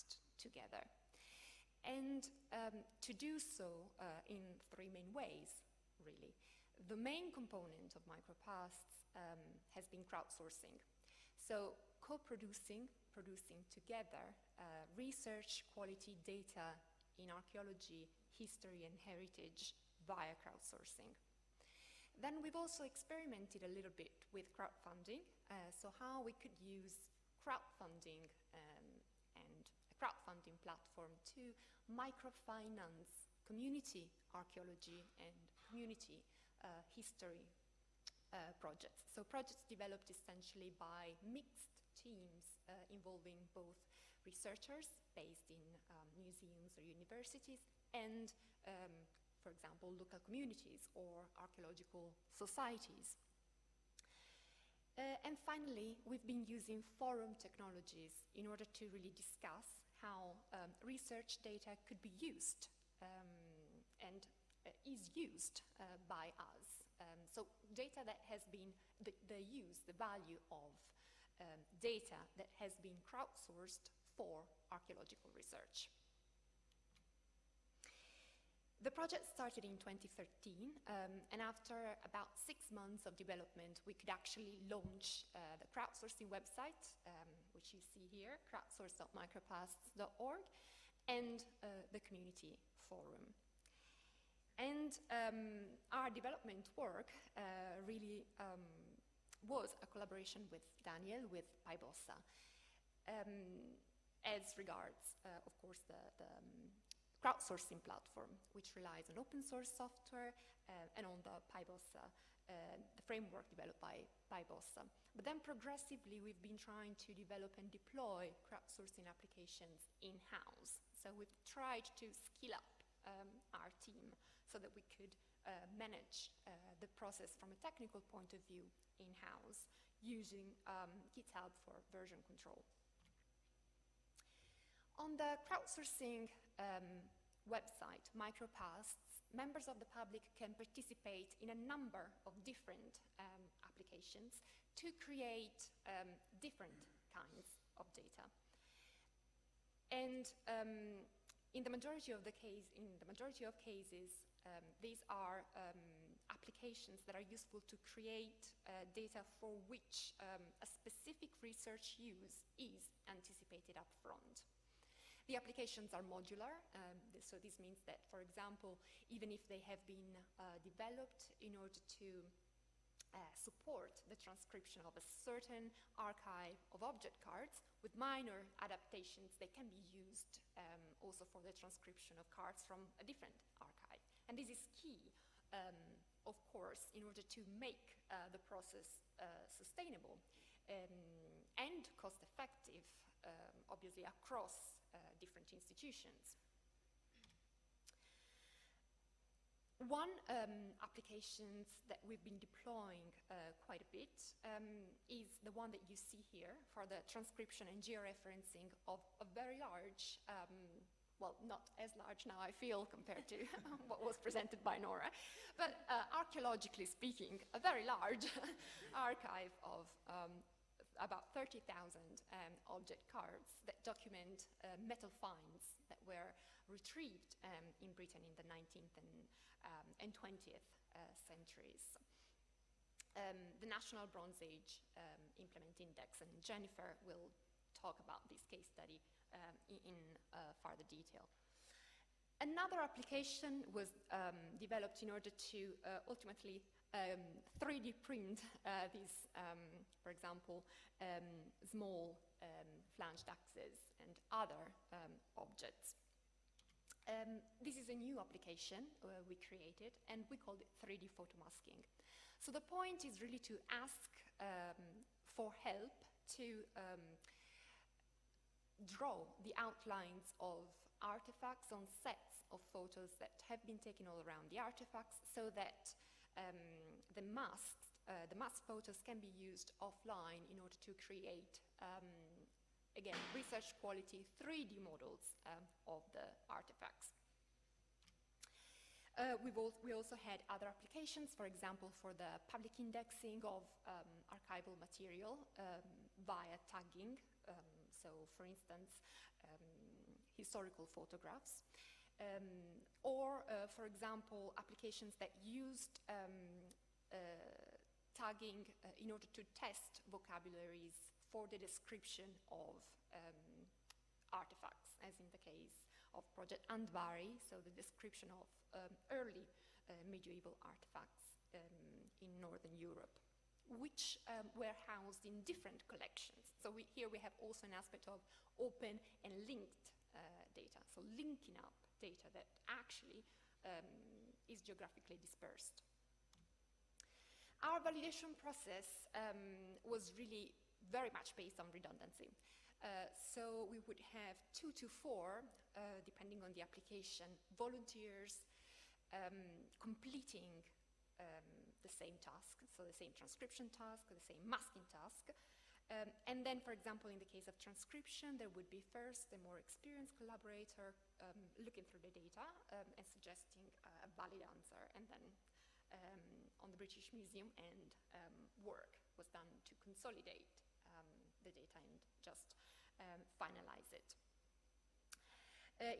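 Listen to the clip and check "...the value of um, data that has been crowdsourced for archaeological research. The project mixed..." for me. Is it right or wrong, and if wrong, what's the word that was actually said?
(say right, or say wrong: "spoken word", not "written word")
wrong: "started", not "mixed".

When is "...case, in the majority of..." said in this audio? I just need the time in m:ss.
2:32.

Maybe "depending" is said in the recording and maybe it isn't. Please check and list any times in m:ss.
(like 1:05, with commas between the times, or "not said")
5:46.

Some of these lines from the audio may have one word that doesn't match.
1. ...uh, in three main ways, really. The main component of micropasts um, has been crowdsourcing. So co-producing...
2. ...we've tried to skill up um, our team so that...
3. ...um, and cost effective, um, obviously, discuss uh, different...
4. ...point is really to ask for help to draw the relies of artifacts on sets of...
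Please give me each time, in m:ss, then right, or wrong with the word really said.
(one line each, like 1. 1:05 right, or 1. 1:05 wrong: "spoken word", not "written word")
1. 0:03 right
2. 2:01 right
3. 3:10 wrong: "across", not "discuss"
4. 4:22 wrong: "outlines", not "relies".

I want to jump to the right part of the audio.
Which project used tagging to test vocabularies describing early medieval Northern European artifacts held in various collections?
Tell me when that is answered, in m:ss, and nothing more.
5:16.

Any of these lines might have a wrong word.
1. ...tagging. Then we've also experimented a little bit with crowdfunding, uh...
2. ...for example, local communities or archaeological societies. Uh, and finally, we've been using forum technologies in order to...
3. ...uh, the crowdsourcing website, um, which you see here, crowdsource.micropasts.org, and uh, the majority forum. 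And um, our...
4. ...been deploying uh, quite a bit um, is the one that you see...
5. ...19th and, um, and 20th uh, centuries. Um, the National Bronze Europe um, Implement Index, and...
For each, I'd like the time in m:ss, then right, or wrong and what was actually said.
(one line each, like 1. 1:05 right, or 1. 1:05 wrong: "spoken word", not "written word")
1. 0:20 wrong: "crowdsourcing", not "tagging"
2. 0:49 right
3. 1:25 wrong: "community", not "majority"
4. 3:22 right
5. 3:48 wrong: "Age", not "Europe".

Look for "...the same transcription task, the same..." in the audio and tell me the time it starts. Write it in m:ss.
5:52.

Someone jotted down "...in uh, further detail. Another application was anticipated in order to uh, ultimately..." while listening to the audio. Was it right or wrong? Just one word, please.
wrong.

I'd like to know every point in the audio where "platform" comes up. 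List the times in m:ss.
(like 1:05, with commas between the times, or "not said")
0:30, 1:47.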